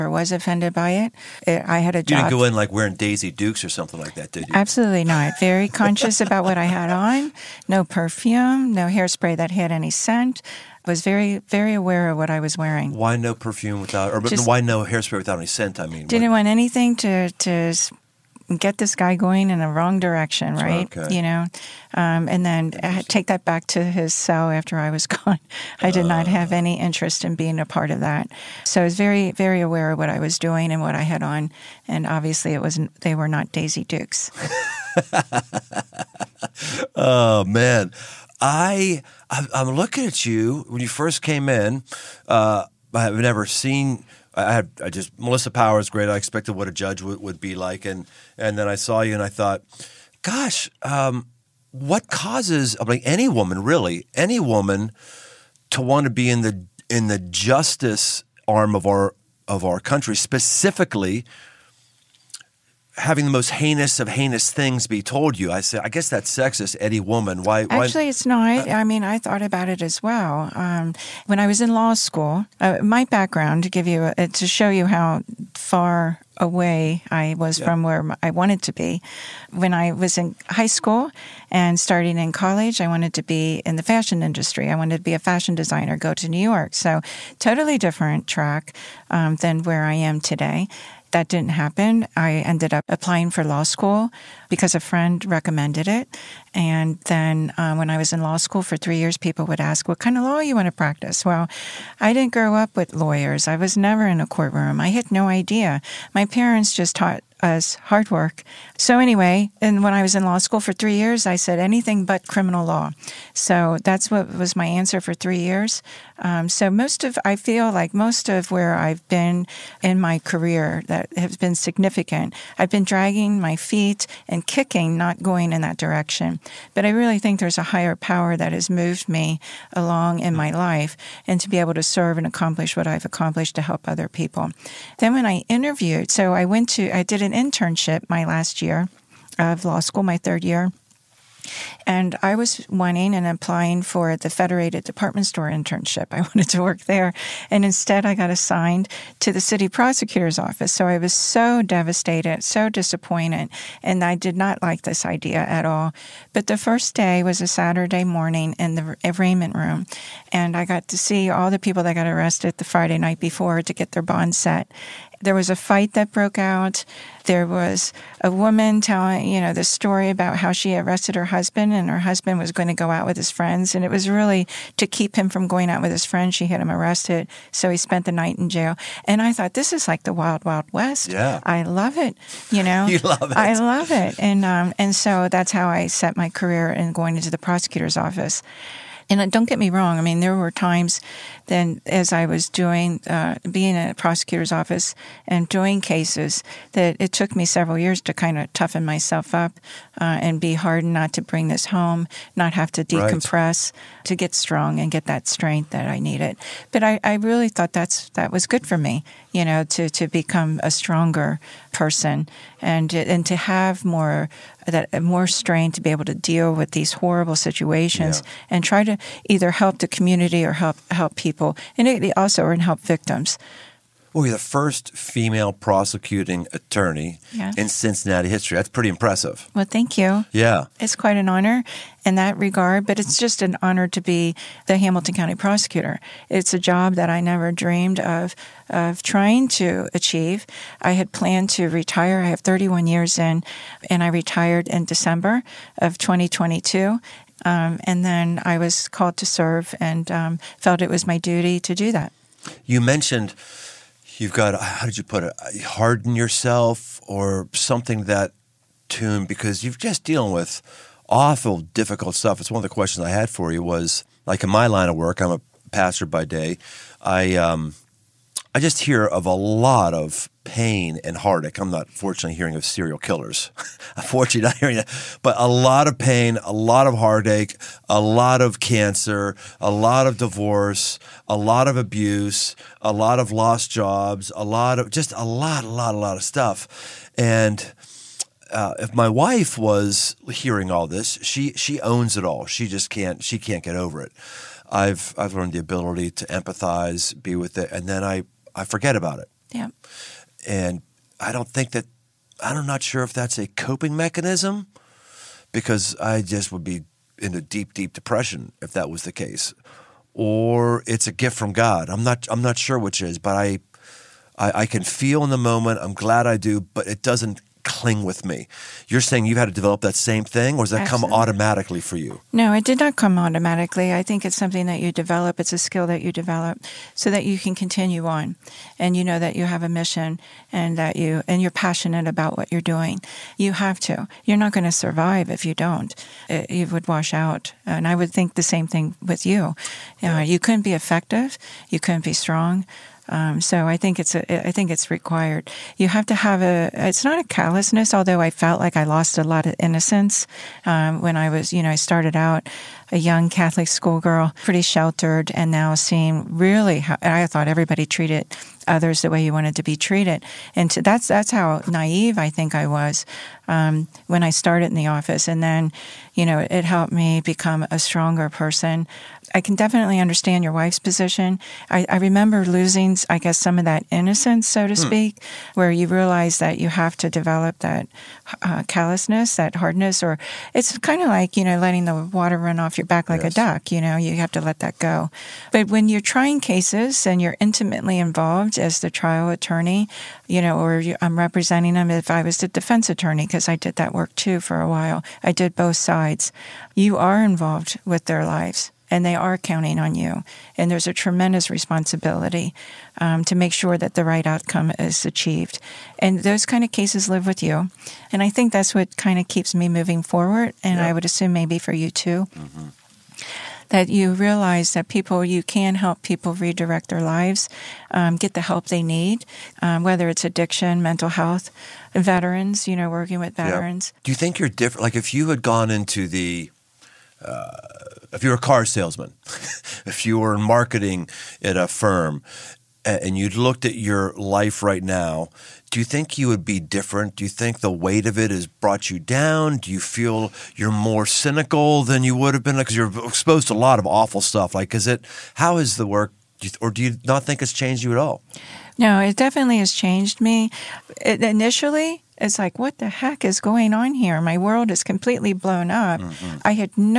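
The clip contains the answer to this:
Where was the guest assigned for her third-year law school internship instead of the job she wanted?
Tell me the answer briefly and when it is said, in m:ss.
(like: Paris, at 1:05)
City prosecutor's office, at 2:29.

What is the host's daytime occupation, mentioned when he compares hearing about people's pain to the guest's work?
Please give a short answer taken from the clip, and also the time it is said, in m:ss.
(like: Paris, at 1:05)
Pastor, at 4:25.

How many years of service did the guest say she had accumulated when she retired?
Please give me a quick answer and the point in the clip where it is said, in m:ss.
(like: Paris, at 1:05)
31, at 4:02.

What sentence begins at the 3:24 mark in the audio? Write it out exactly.
to get strong and get that strength that I needed.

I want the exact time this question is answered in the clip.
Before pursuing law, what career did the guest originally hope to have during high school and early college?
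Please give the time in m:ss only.
1:25.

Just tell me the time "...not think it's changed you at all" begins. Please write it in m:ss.
7:27.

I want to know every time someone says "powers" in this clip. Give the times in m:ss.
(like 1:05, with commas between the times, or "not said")
0:45, 2:07.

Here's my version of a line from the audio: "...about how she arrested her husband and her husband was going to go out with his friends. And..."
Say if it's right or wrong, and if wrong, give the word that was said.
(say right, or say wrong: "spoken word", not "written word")
right.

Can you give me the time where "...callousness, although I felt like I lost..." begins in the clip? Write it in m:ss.
5:47.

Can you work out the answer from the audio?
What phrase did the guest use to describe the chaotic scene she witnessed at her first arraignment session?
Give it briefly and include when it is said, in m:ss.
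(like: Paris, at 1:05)
Wild Wild West, at 3:00.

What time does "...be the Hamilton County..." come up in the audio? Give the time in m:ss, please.
3:53.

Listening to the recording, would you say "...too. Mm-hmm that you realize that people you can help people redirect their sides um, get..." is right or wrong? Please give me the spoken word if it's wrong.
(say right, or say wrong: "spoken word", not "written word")
wrong: "lives", not "sides".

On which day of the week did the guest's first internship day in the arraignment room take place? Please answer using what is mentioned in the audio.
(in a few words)
Saturday.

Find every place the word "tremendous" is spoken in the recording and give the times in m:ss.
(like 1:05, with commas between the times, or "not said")
6:40.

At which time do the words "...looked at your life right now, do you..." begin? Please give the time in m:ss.
7:13.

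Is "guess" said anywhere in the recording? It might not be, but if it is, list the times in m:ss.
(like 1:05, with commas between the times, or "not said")
1:05, 6:13.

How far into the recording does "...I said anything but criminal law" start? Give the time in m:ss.
1:51.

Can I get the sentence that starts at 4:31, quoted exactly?
I'm not fortunately hearing of serial killers.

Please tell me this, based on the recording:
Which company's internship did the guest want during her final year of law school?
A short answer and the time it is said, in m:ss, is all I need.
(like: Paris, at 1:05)
Federated Department Store, at 2:24.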